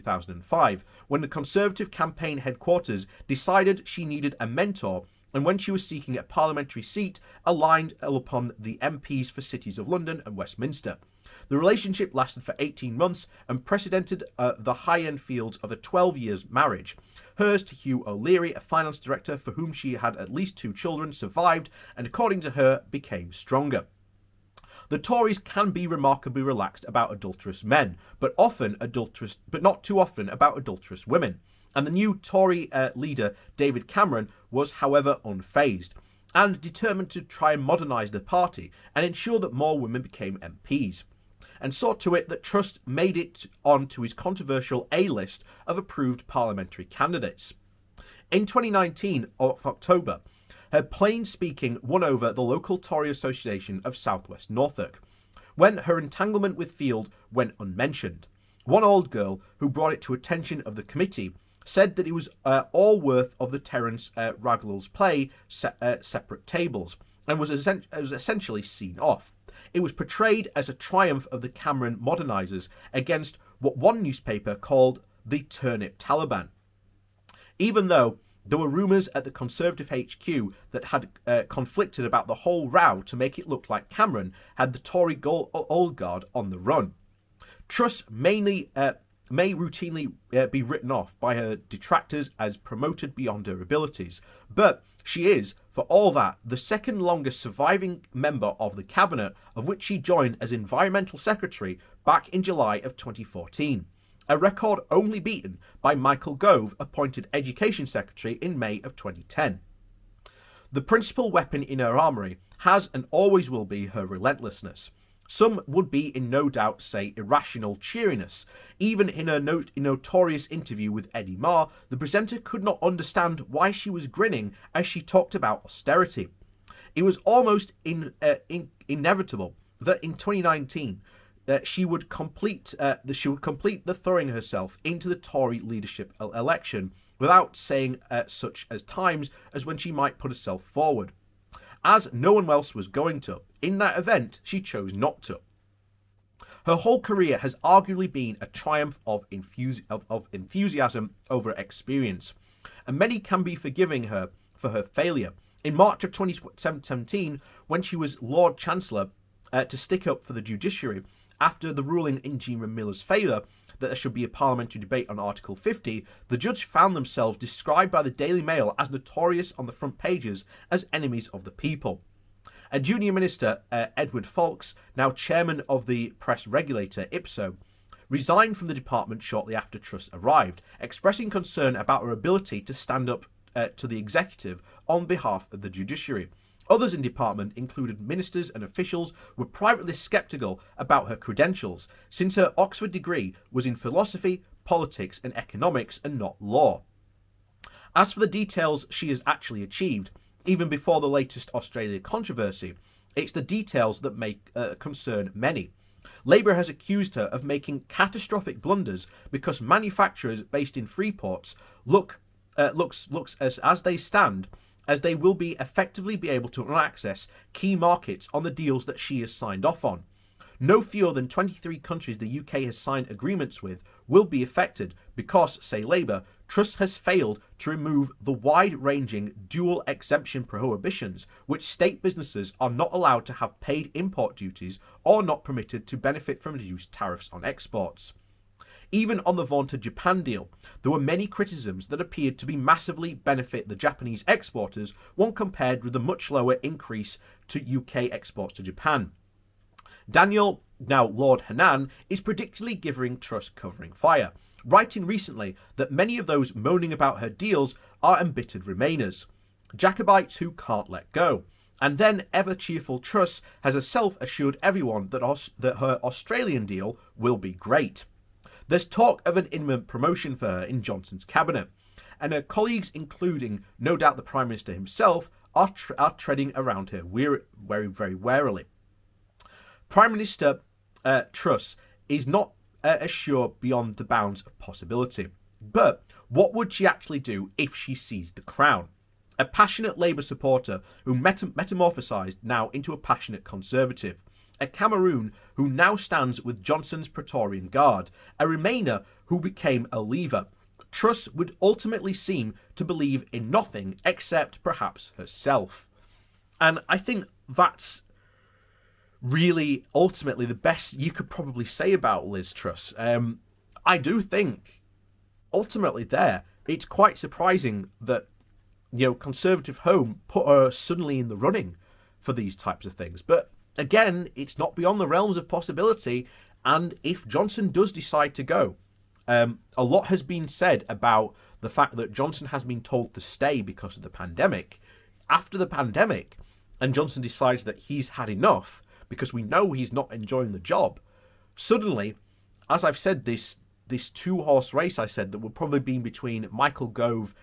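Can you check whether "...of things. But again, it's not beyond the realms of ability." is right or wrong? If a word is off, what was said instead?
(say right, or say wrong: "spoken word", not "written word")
wrong: "possibility", not "ability".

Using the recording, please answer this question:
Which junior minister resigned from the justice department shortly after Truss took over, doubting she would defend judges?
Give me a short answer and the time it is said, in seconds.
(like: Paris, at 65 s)
Edward Faulks, at 173 s.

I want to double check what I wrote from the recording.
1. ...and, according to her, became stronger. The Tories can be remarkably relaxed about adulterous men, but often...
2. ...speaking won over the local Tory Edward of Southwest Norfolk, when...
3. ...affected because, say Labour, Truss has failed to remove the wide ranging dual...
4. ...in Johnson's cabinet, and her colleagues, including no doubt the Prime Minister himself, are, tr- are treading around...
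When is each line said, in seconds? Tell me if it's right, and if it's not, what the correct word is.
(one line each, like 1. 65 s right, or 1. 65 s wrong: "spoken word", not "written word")
1. 21 s right
2. 51 s wrong: "Association", not "Edward"
3. 224 s right
4. 270 s right.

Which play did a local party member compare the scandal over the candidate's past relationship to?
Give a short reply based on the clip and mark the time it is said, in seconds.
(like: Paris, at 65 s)
Separate Tables, at 65 s.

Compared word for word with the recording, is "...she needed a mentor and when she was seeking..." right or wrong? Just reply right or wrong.
right.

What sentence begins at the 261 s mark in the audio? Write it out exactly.
And then ever cheerful Truss has herself assured everyone that, that her Australian deal will be great.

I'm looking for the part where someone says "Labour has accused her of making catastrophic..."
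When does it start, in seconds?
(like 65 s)
206 s.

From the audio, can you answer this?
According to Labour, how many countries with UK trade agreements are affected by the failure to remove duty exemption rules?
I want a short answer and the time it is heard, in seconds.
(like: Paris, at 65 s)
23, at 221 s.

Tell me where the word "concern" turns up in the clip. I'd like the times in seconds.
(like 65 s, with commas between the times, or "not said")
181 s, 204 s.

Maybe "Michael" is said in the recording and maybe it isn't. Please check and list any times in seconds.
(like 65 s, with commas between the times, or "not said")
105 s, 346 s.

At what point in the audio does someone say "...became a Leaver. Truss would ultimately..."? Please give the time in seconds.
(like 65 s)
299 s.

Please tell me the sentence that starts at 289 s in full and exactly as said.
A passionate Labour supporter who meta- metamorphosised now into a passionate Conservative.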